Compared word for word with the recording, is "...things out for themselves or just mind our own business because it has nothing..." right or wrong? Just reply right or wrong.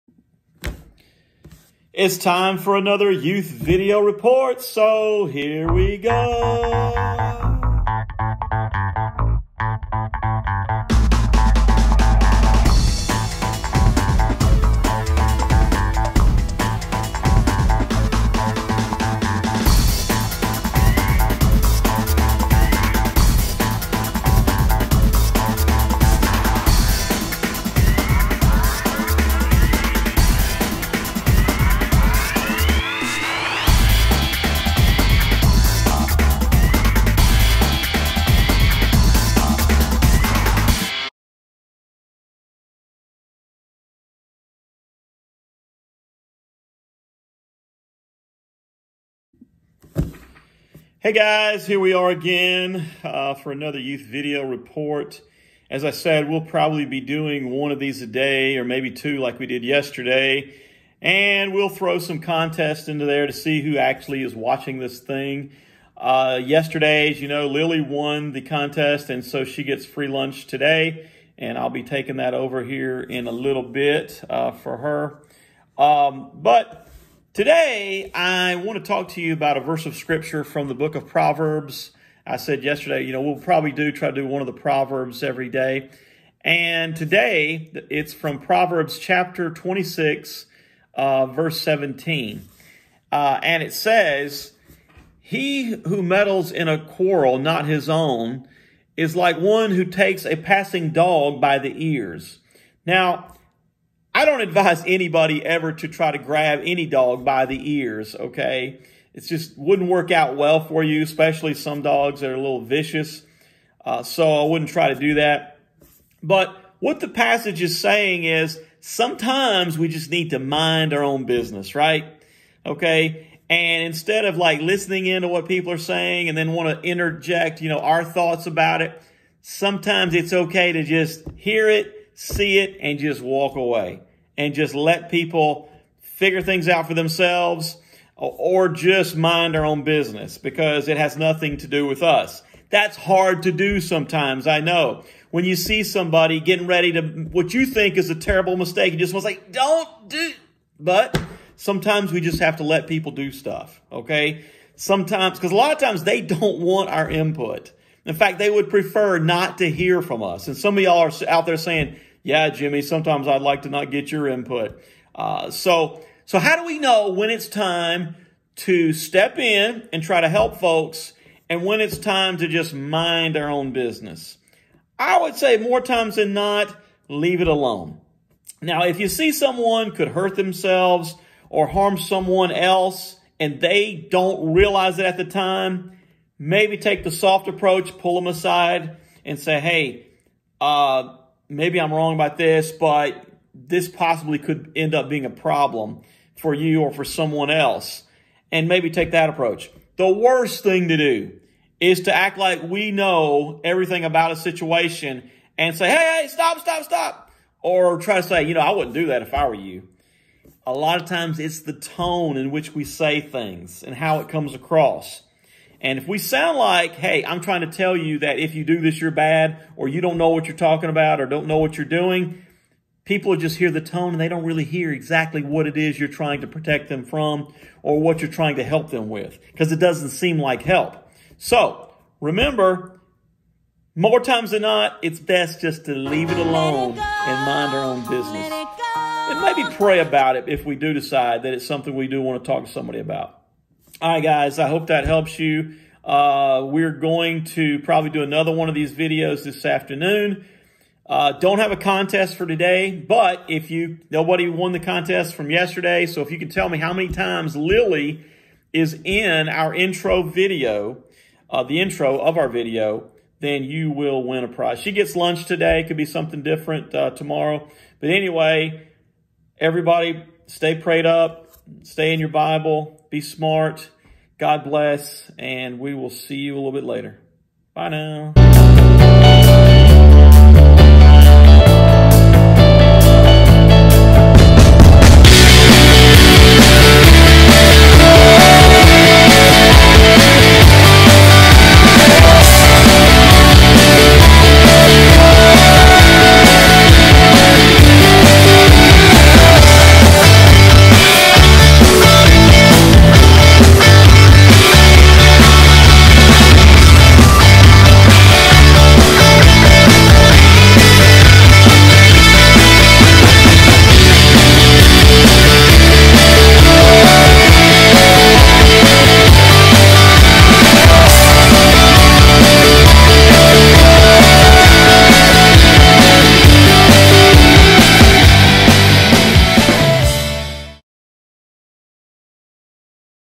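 right.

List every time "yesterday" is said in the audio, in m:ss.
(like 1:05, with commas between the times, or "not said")
0:59, 1:06, 1:22, 4:15.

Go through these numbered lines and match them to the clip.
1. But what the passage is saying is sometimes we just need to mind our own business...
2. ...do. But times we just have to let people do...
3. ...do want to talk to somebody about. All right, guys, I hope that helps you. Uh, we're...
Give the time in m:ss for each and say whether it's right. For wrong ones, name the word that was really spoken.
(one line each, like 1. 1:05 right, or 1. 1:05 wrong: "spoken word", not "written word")
1. 1:56 right
2. 2:30 wrong: "sometimes", not "times"
3. 4:02 right.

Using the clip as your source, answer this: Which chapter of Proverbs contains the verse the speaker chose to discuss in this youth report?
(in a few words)
26.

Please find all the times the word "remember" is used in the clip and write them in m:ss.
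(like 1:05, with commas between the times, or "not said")
3:52.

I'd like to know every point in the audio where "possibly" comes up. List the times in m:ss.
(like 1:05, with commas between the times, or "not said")
3:13.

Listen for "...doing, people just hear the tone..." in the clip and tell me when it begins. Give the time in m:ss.
3:41.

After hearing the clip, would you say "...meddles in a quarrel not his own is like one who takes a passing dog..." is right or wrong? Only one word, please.
right.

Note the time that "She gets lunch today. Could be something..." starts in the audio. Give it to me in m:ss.
4:24.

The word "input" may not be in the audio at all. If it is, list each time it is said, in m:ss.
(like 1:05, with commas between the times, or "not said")
2:37, 2:44.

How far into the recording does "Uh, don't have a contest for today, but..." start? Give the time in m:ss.
4:11.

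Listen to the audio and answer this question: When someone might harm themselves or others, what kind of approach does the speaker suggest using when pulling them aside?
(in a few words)
The soft approach.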